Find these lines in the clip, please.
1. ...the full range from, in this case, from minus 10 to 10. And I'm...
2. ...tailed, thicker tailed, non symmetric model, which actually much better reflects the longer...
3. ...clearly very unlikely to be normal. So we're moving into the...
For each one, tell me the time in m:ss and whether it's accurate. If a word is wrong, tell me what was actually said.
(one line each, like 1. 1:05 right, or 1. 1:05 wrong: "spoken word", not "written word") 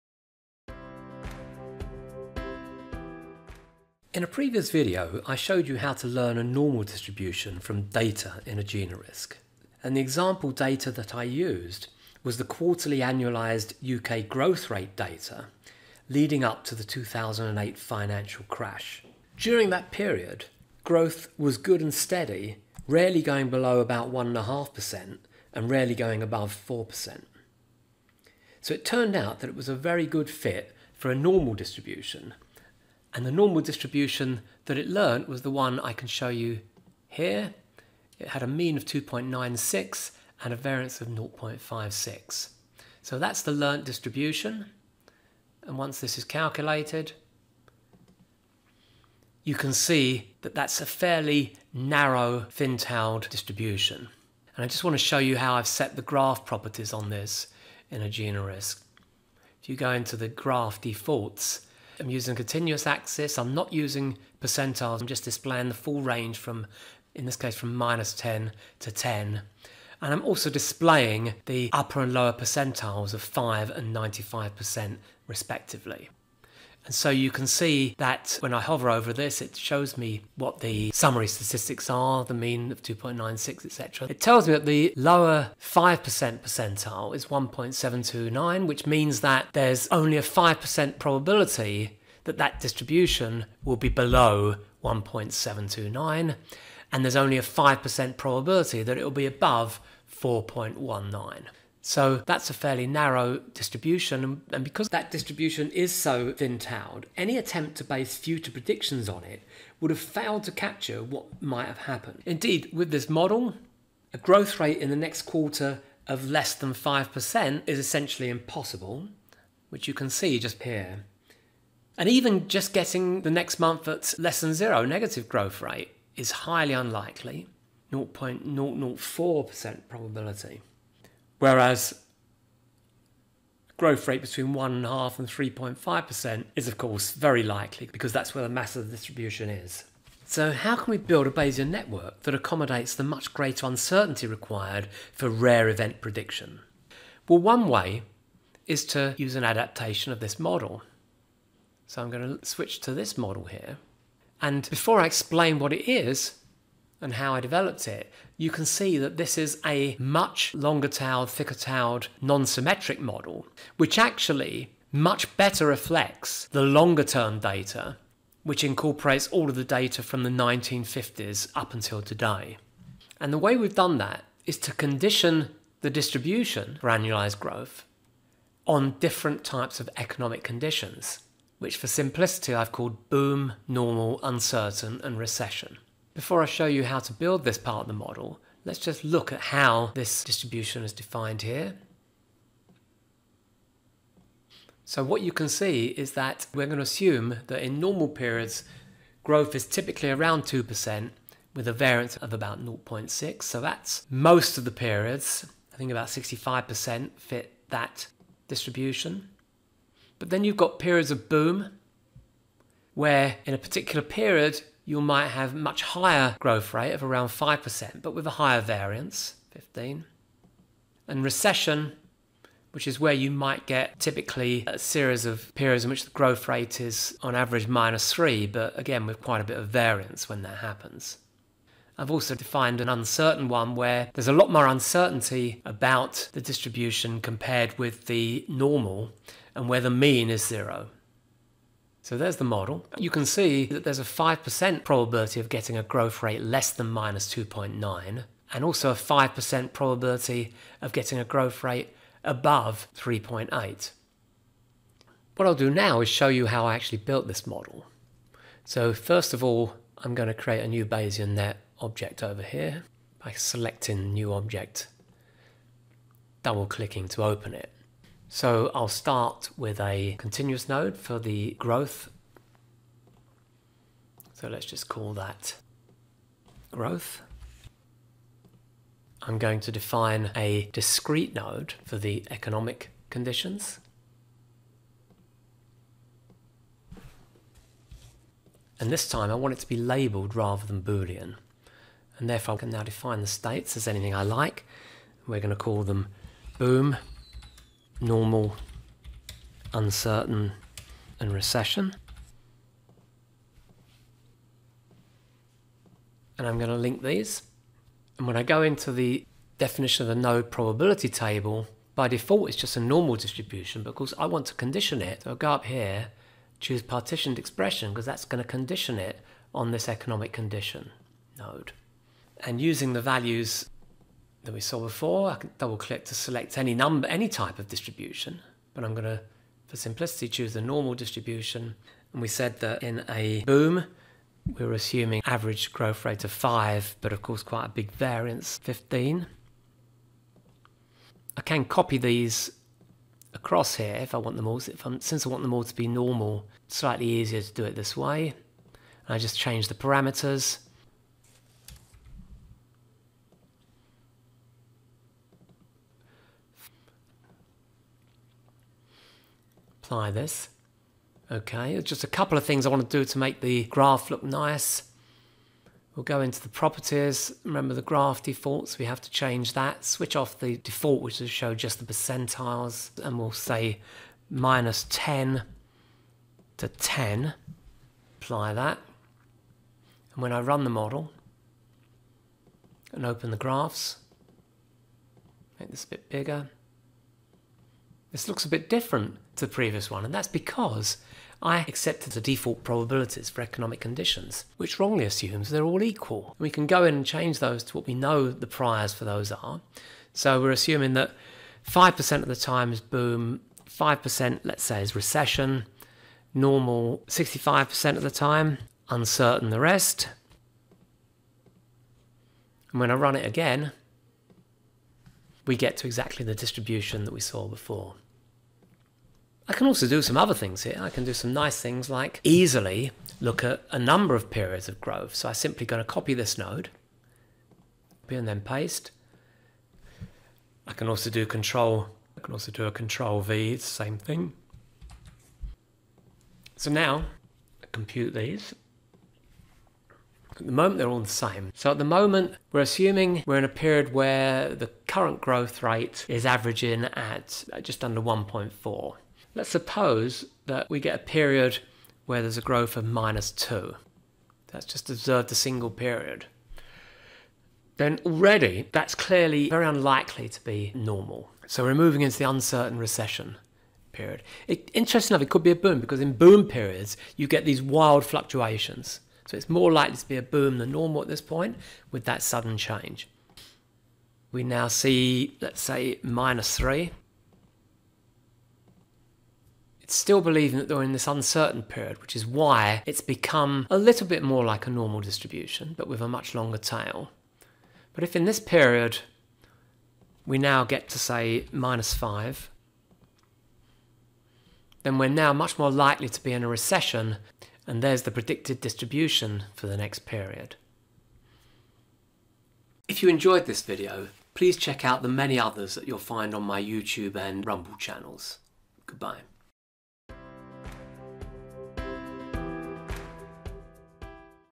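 1. 1:05 right
2. 2:40 right
3. 7:38 right.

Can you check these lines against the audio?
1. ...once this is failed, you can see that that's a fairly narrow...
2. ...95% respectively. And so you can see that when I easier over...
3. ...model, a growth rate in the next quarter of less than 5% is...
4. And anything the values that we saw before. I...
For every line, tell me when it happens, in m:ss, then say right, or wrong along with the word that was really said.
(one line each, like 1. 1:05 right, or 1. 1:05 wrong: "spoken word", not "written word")
1. 0:45 wrong: "calculated", not "failed"
2. 1:13 wrong: "hover", not "easier"
3. 1:53 right
4. 5:22 wrong: "using", not "anything".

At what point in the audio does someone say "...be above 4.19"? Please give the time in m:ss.
1:39.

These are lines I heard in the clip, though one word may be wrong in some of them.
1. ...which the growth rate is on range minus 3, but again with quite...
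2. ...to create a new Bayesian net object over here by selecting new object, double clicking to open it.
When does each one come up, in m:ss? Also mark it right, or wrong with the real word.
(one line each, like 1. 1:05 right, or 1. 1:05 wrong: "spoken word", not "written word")
1. 3:45 wrong: "average", not "range"
2. 4:20 right.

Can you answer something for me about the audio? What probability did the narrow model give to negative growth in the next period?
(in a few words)
0.004%.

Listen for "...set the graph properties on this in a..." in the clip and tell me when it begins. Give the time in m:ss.
0:55.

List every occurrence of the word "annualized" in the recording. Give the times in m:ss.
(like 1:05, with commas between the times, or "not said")
0:12, 2:56.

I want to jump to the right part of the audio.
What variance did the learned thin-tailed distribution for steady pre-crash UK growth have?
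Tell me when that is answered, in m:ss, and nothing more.
0:40.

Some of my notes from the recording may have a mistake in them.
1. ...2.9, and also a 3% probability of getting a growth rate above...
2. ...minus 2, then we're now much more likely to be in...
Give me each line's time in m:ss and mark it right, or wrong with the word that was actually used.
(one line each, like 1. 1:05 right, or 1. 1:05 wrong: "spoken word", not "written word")
1. 4:07 wrong: "5", not "3"
2. 8:11 wrong: "5", not "2".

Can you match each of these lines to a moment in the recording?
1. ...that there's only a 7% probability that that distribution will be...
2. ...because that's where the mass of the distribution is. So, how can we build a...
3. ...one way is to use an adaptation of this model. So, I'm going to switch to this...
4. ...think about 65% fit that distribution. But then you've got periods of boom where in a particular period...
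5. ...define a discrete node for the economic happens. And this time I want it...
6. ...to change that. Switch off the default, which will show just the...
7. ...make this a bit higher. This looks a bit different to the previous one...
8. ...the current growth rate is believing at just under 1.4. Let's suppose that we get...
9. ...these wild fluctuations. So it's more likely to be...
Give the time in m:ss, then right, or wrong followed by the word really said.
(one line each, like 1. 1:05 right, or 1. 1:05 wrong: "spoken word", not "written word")
1. 1:29 wrong: "5", not "7"
2. 2:17 right
3. 2:27 right
4. 3:25 right
5. 4:39 wrong: "conditions", not "happens"
6. 6:09 right
7. 6:25 wrong: "bigger", not "higher"
8. 7:24 wrong: "averaging", not "believing"
9. 7:47 right.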